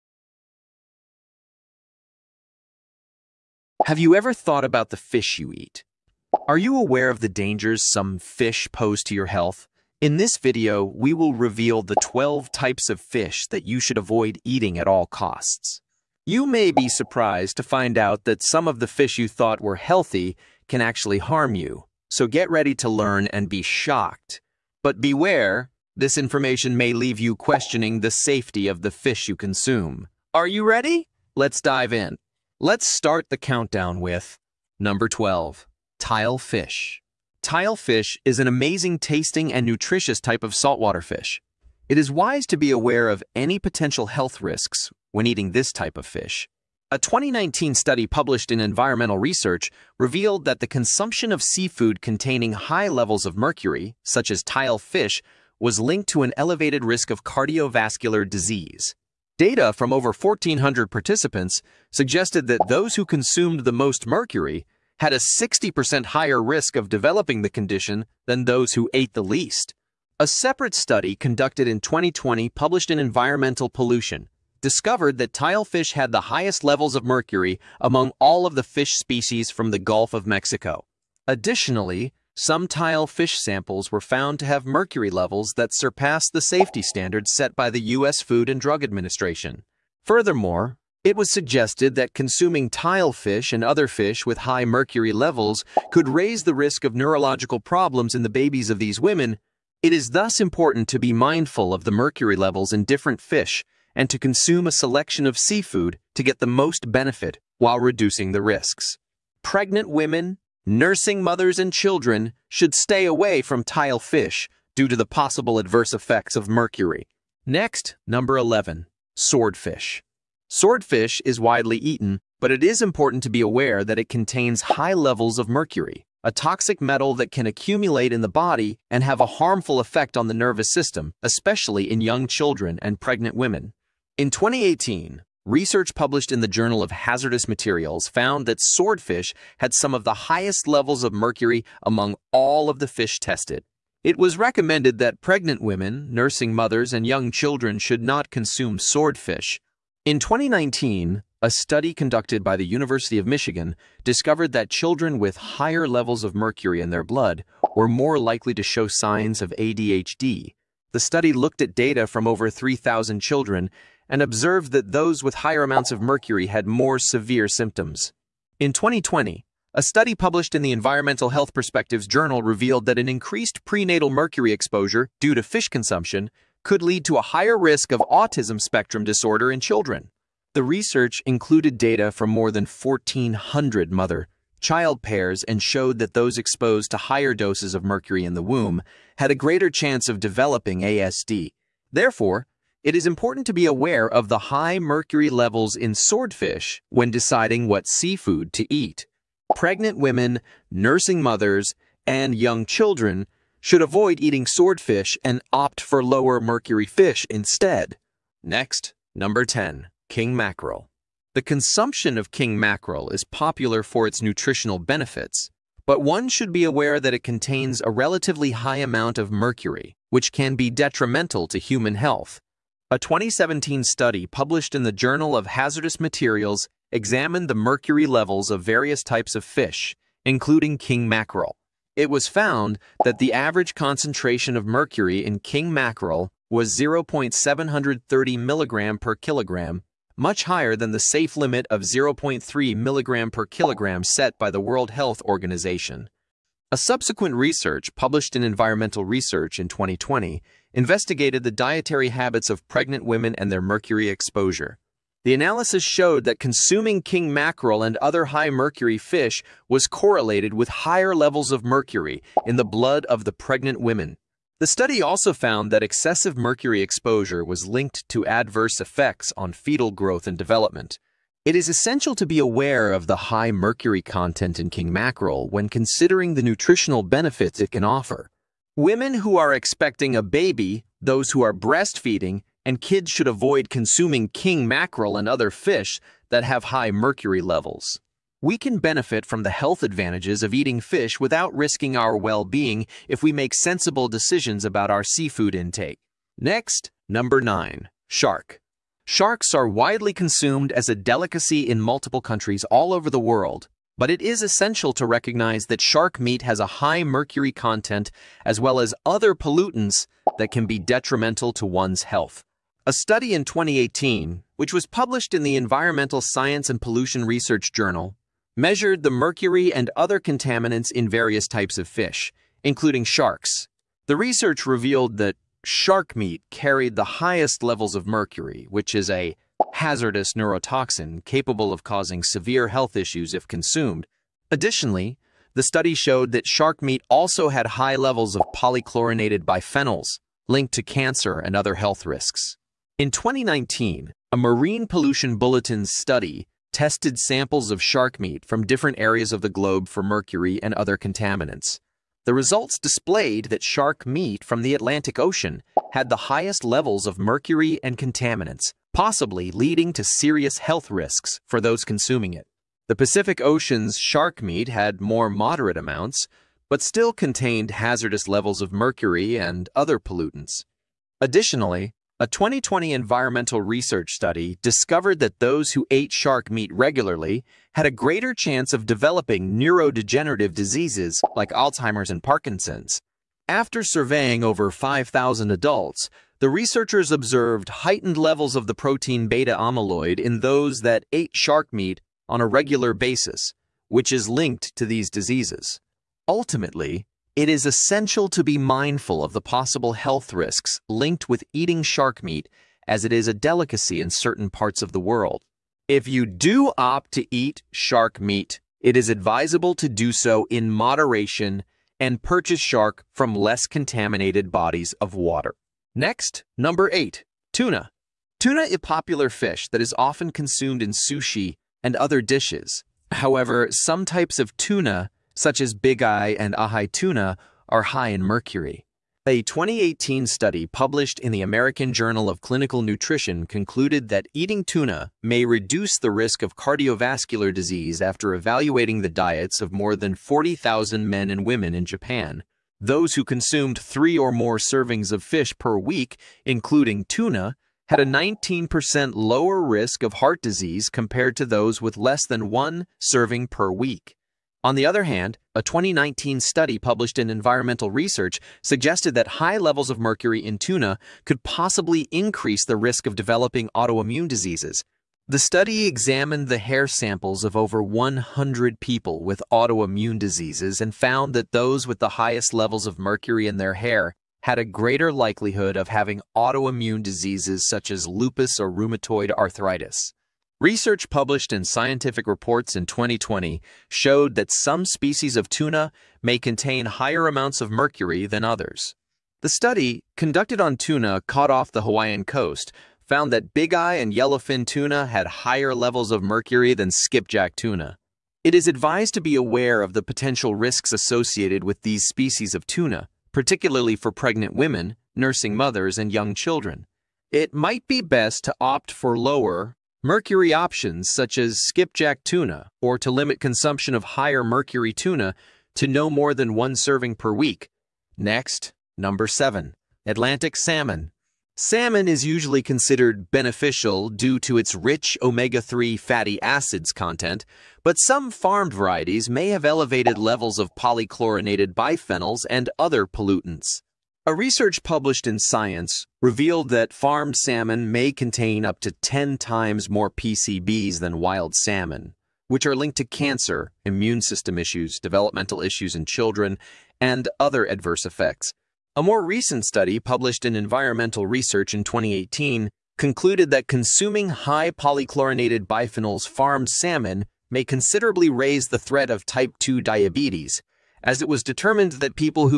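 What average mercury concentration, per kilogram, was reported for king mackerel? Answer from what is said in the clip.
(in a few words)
0.730 milligram.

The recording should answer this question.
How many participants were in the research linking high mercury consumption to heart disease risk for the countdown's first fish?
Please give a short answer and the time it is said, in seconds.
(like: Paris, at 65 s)
over 1,400, at 59 s.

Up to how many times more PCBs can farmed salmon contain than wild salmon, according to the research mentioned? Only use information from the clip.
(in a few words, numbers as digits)
10 times.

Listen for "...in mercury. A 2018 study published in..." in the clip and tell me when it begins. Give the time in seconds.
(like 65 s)
428 s.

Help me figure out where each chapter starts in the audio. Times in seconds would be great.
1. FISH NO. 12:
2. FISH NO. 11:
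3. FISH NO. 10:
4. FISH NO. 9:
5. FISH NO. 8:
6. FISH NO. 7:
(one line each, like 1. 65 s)
1. 35 s
2. 118 s
3. 209 s
4. 297 s
5. 415 s
6. 519 s.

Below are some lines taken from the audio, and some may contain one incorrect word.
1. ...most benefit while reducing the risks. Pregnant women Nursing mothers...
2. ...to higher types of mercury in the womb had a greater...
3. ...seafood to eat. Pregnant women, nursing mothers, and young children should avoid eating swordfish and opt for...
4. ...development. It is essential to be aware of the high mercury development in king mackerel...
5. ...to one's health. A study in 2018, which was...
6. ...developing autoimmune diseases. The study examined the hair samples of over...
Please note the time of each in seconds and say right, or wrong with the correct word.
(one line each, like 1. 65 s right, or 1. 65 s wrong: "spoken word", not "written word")
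1. 106 s right
2. 186 s wrong: "doses", not "types"
3. 197 s right
4. 270 s wrong: "content", not "development"
5. 311 s right
6. 463 s right.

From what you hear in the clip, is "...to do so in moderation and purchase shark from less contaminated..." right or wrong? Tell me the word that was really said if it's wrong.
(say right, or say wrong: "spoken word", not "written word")
right.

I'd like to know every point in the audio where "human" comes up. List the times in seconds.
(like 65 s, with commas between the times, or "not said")
221 s.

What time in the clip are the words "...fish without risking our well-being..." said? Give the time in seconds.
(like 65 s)
290 s.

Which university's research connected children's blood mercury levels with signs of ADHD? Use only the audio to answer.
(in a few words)
University of Michigan.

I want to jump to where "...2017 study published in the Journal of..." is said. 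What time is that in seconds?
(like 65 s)
222 s.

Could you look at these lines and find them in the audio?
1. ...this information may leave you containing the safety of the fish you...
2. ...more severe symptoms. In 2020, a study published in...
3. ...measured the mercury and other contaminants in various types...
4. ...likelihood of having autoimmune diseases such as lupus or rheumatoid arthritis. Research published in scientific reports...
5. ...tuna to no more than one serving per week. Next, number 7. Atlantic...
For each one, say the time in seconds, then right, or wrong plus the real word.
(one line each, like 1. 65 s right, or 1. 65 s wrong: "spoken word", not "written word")
1. 25 s wrong: "questioning", not "containing"
2. 166 s right
3. 318 s right
4. 475 s right
5. 514 s right.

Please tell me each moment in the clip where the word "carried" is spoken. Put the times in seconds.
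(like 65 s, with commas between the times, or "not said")
326 s.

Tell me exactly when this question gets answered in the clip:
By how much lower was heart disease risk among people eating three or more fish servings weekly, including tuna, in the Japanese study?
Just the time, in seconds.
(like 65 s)
448 s.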